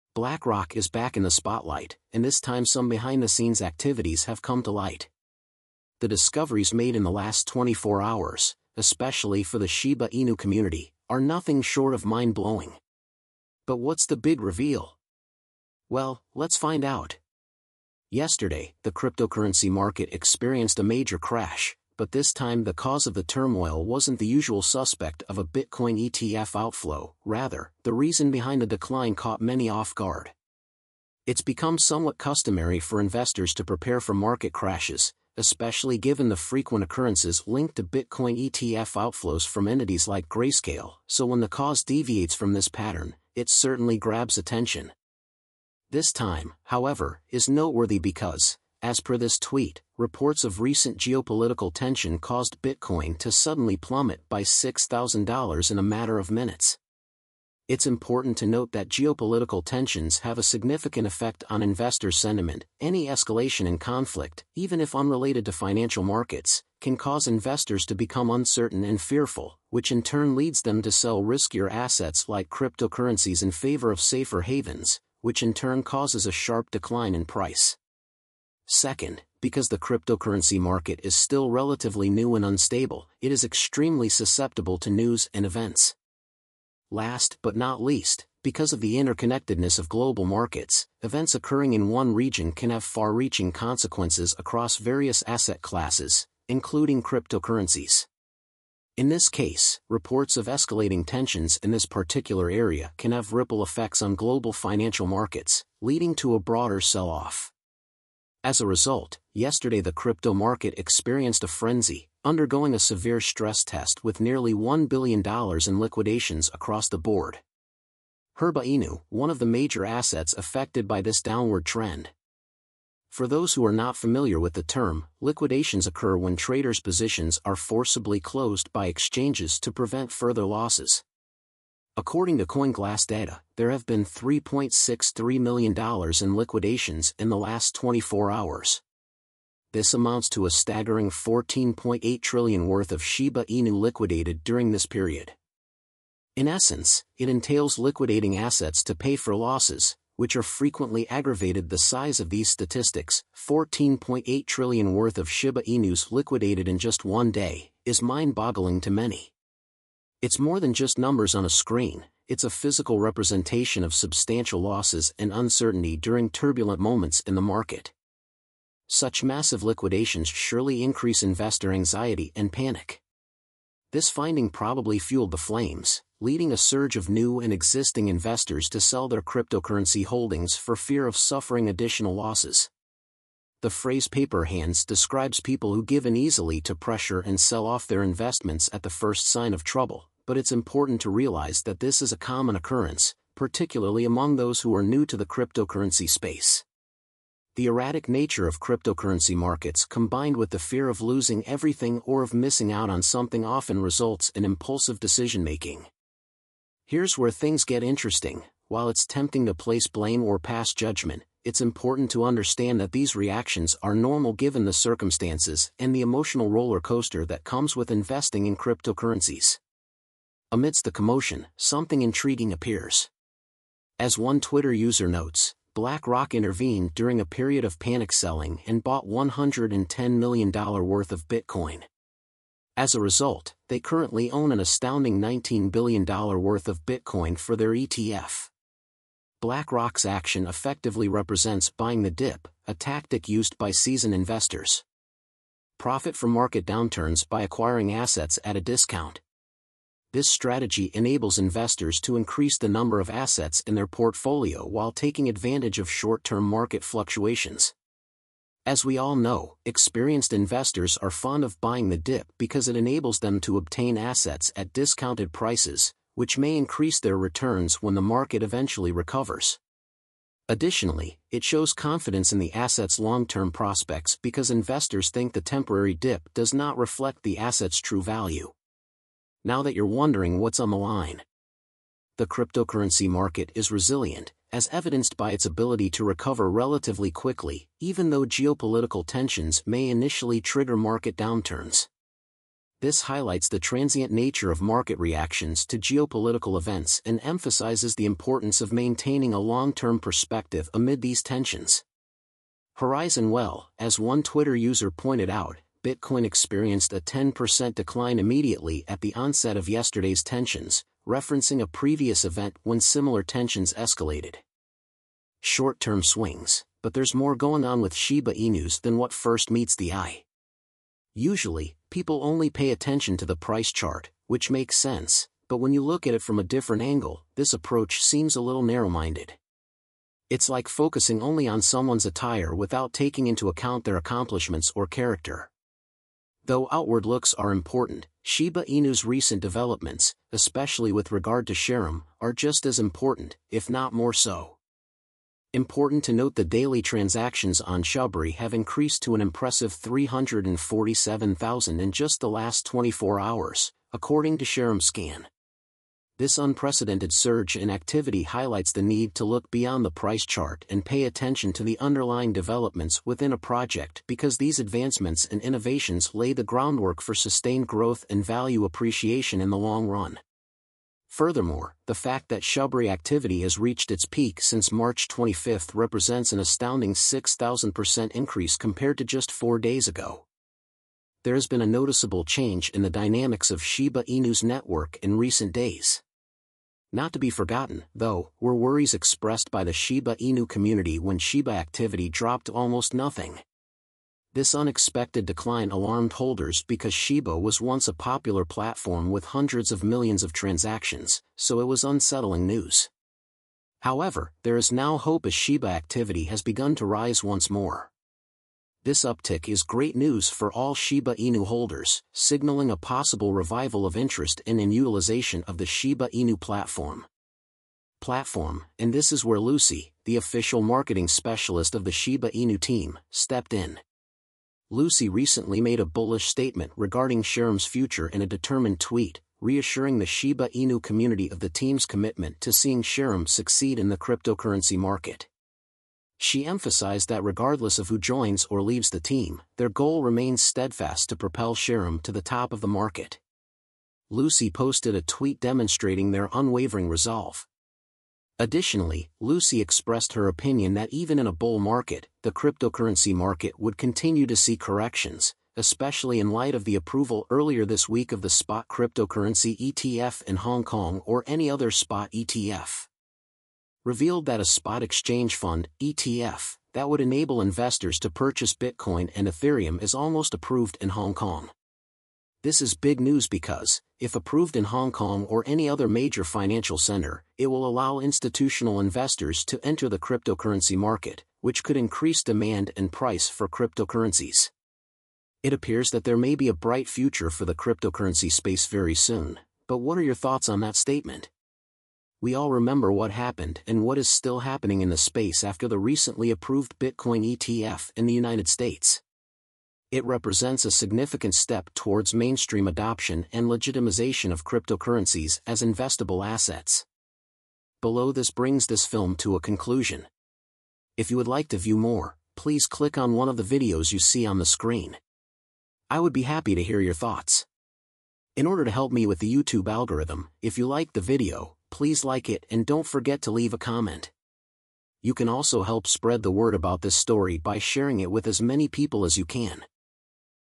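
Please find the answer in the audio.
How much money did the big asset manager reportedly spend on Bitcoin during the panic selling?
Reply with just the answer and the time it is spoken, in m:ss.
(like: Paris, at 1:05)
$110 million, at 3:49.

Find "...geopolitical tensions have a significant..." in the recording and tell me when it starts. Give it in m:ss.
0:58.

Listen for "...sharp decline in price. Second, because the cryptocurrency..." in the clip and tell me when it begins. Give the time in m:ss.
1:16.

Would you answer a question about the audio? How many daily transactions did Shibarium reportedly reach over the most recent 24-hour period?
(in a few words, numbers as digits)
347,000.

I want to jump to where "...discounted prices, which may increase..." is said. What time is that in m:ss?
4:24.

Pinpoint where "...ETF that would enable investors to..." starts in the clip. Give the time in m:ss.
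7:45.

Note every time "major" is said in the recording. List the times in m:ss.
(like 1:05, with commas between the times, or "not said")
0:20, 1:59, 7:55.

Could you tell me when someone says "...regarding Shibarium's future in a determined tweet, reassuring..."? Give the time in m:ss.
7:06.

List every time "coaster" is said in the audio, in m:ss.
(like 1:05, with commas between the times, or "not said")
3:36.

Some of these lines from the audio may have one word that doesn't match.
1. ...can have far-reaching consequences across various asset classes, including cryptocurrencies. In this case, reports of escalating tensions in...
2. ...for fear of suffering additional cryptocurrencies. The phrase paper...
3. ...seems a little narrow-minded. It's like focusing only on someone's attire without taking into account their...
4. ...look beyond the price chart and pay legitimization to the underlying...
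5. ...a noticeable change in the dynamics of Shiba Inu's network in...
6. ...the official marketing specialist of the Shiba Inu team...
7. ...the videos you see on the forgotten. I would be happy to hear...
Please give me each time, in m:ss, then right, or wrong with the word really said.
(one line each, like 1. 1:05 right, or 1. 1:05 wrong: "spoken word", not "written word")
1. 1:32 right
2. 3:00 wrong: "losses", not "cryptocurrencies"
3. 5:28 right
4. 5:59 wrong: "attention", not "legitimization"
5. 6:21 right
6. 7:00 right
7. 8:33 wrong: "screen", not "forgotten".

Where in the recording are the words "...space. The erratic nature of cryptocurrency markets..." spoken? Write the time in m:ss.
3:16.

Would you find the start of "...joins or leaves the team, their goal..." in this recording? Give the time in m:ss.
7:17.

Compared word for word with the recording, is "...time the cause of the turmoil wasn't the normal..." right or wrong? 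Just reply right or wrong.
wrong.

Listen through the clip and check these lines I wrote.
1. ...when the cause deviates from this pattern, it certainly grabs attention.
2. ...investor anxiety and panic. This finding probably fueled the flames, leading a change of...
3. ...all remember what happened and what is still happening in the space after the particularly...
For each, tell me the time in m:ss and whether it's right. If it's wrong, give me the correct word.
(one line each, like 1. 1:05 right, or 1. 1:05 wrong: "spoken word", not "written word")
1. 0:41 right
2. 2:51 wrong: "surge", not "change"
3. 8:12 wrong: "recently", not "particularly".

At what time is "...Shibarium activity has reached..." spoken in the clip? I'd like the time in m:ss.
6:12.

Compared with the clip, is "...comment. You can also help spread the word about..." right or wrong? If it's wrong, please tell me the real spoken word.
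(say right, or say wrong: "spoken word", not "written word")
right.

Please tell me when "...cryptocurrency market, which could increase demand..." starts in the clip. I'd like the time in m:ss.
7:59.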